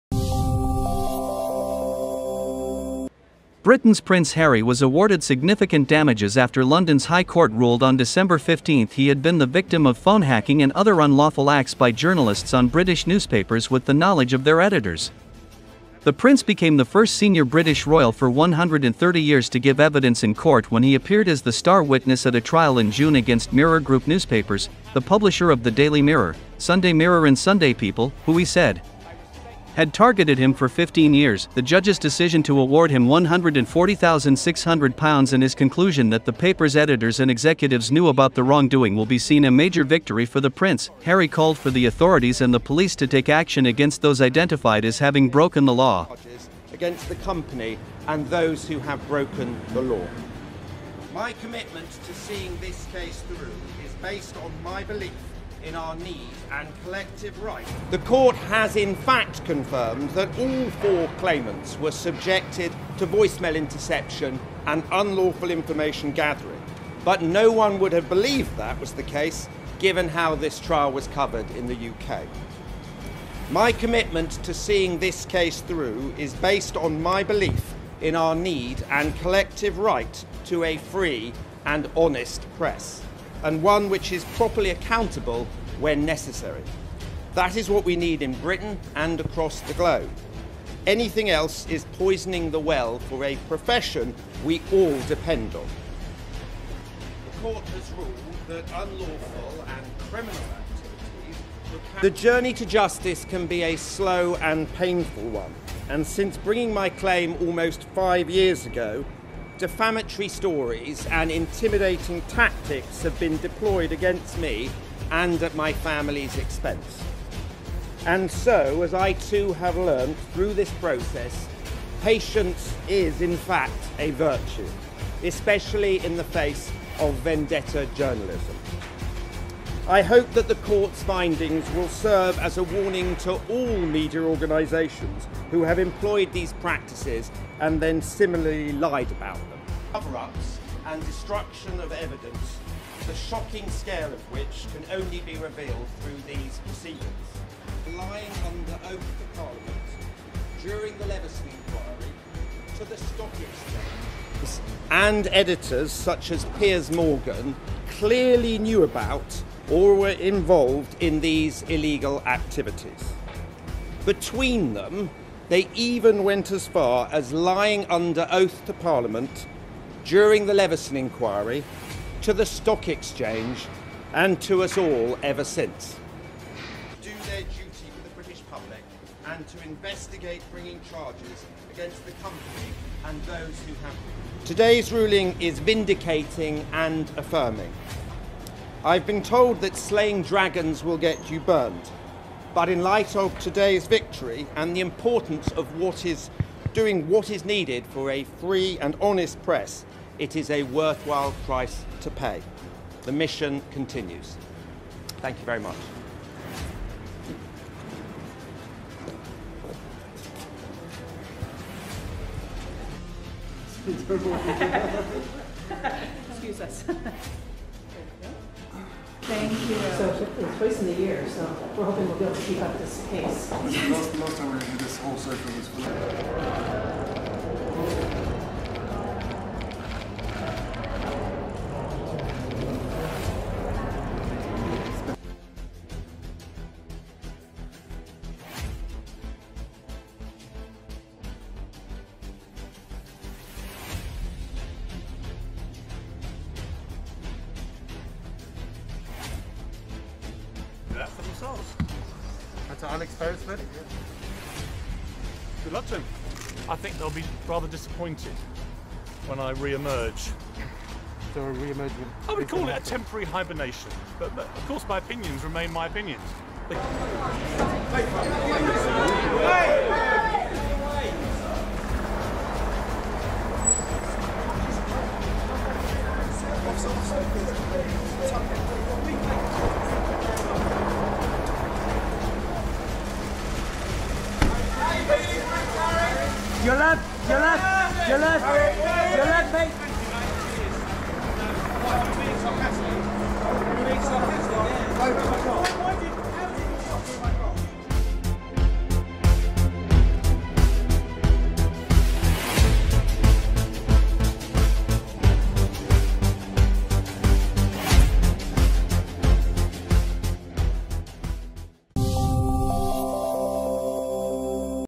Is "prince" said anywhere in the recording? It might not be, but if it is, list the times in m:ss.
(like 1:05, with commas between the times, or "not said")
0:04, 0:16, 0:40.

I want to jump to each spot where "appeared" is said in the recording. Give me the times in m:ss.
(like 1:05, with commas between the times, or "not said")
0:20.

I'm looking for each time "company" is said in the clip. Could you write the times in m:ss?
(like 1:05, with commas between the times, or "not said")
0:47, 3:02.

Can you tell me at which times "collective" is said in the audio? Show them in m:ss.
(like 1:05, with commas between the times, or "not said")
0:56, 1:19.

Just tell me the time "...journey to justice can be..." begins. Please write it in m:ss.
1:42.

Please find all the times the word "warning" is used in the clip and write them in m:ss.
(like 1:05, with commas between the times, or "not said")
2:12.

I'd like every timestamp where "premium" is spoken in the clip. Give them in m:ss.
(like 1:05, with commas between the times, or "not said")
not said.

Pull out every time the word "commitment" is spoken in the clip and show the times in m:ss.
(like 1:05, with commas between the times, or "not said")
0:51, 1:13.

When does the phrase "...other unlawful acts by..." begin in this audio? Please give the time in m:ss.
0:10.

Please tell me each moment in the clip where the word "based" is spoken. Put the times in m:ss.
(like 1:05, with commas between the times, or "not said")
0:54, 1:16.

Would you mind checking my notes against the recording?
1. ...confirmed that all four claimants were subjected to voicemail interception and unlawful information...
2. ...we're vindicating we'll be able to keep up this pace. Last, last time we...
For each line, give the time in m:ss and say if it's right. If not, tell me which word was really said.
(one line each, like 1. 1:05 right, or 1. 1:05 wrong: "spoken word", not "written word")
1. 0:59 right
2. 3:41 wrong: "hoping", not "vindicating".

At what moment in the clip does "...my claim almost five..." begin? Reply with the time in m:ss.
1:46.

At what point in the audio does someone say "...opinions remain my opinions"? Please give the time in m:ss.
4:24.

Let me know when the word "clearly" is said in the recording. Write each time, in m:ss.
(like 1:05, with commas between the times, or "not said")
2:37.